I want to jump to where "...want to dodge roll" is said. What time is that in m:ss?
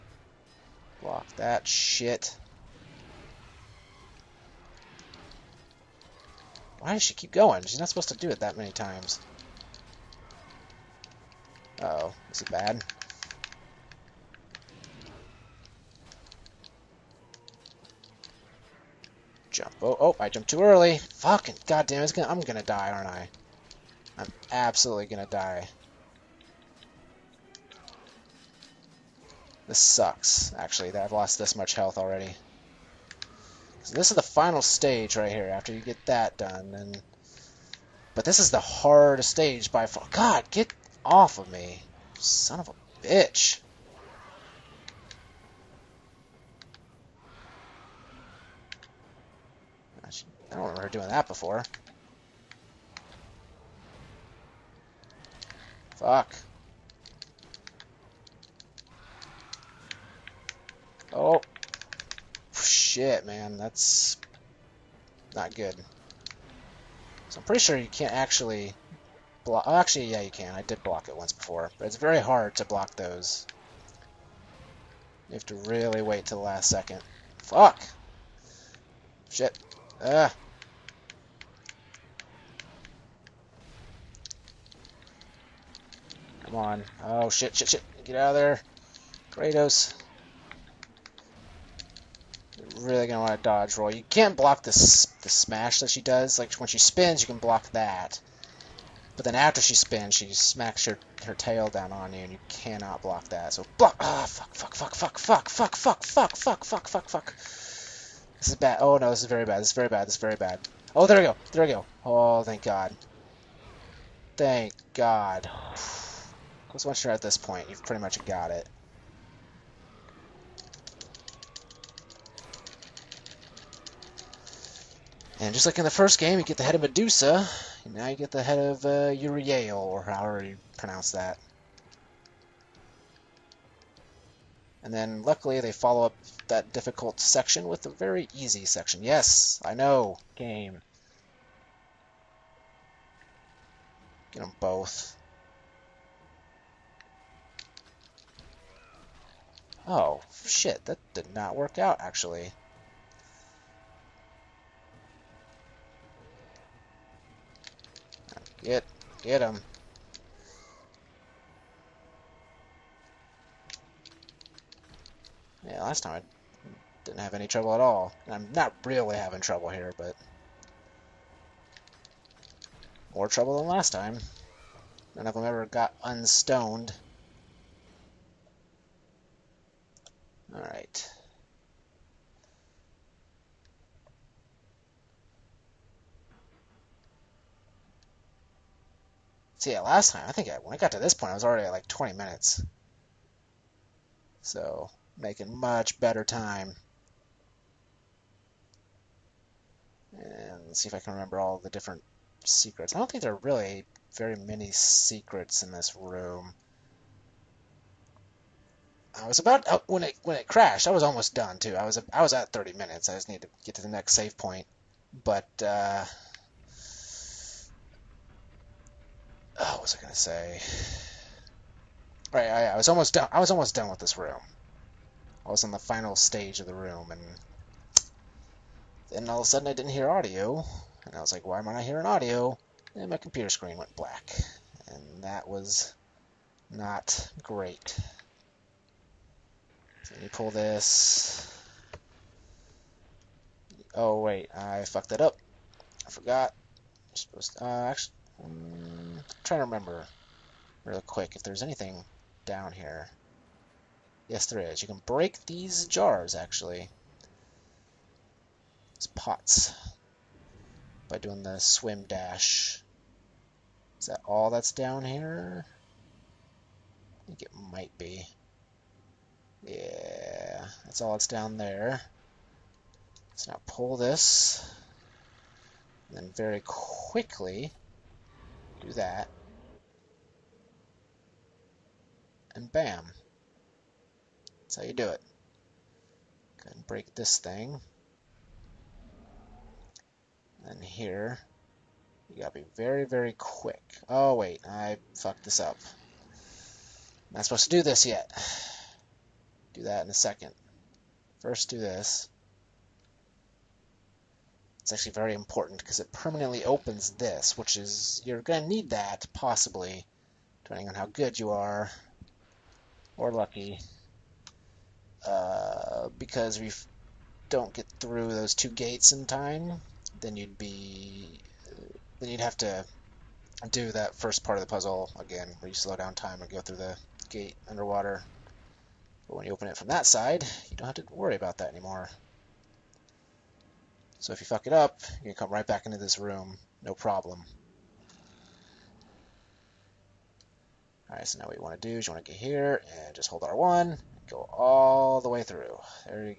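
1:33.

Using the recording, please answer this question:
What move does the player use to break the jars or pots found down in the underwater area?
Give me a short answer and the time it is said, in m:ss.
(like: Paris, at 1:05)
swim dash, at 4:21.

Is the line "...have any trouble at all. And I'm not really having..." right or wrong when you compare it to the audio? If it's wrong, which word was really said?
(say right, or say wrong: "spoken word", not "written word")
right.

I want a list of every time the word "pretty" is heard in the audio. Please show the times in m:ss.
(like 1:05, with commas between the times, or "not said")
1:07, 1:57.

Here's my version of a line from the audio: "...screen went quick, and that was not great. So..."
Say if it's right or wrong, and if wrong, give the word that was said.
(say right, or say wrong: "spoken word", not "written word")
wrong: "black", not "quick".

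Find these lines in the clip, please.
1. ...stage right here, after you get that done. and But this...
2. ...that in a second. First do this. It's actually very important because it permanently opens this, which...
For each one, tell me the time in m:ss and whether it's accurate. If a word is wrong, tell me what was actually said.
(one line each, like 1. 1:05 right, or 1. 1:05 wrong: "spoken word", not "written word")
1. 0:34 right
2. 4:59 right.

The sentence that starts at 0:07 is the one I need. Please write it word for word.
She's not supposed to do it that many times.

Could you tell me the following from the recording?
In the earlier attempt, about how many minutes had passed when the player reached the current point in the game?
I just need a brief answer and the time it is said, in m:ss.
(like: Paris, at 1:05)
20, at 3:11.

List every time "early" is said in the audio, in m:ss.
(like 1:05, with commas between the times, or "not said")
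0:20.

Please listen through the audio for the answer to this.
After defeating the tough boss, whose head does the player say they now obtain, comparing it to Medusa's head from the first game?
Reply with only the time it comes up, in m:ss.
2:09.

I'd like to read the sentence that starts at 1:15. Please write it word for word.
You have to really wait till the last second.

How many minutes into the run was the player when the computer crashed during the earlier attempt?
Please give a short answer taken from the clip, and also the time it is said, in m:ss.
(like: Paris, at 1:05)
30, at 3:32.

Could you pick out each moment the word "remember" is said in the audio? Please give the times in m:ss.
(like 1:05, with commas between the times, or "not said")
0:50, 3:21, 4:09.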